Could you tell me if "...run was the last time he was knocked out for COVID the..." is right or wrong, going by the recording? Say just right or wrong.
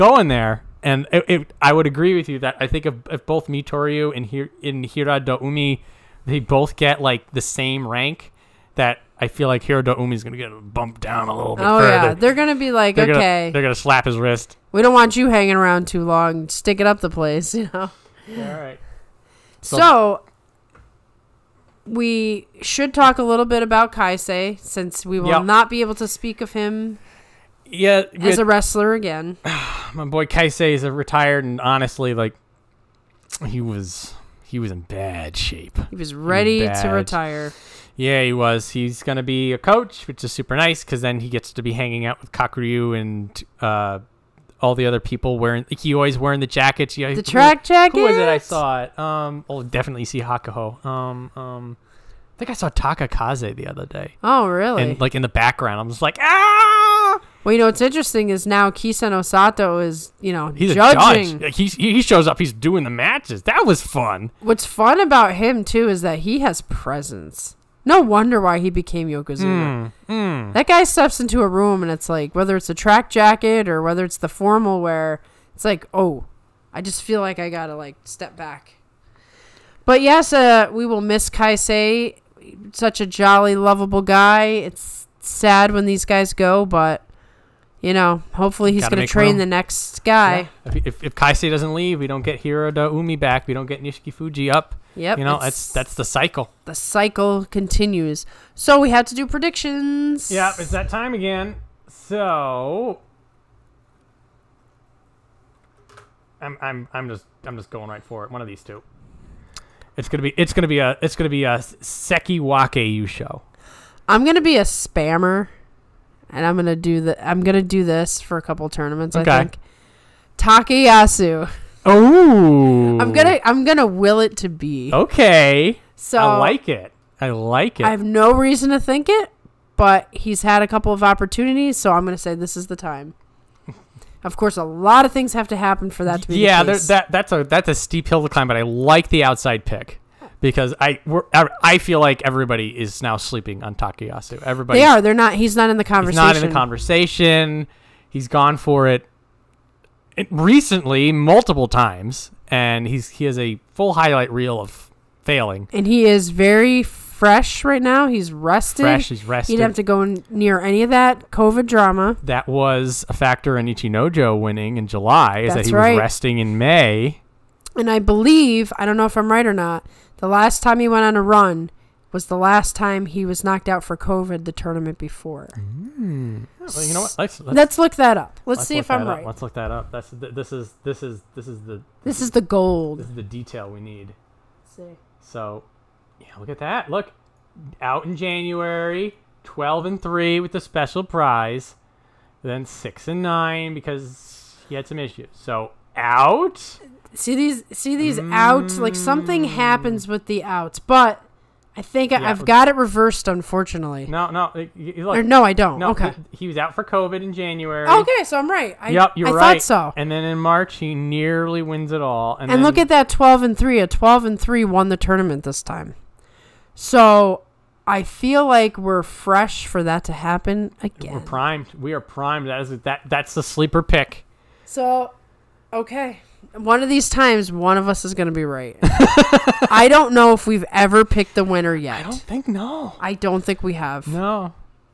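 right.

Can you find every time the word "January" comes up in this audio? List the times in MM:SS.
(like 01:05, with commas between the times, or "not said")
03:08, 03:27.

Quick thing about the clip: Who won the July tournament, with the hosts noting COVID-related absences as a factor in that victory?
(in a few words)
Ichinojo.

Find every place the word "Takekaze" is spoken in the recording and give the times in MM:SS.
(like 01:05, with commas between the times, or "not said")
00:52.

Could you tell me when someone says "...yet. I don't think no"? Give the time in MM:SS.
03:51.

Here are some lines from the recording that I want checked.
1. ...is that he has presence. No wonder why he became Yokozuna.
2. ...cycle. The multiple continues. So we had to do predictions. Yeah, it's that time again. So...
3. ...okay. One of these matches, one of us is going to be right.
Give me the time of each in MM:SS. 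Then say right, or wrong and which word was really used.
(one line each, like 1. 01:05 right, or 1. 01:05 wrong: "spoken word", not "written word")
1. 01:05 right
2. 01:36 wrong: "cycle", not "multiple"
3. 03:45 wrong: "times", not "matches".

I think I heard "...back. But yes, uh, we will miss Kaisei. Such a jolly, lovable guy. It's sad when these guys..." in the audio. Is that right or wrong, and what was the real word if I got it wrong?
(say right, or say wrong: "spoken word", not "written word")
right.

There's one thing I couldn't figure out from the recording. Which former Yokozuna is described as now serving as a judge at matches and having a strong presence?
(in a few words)
Kisenosato.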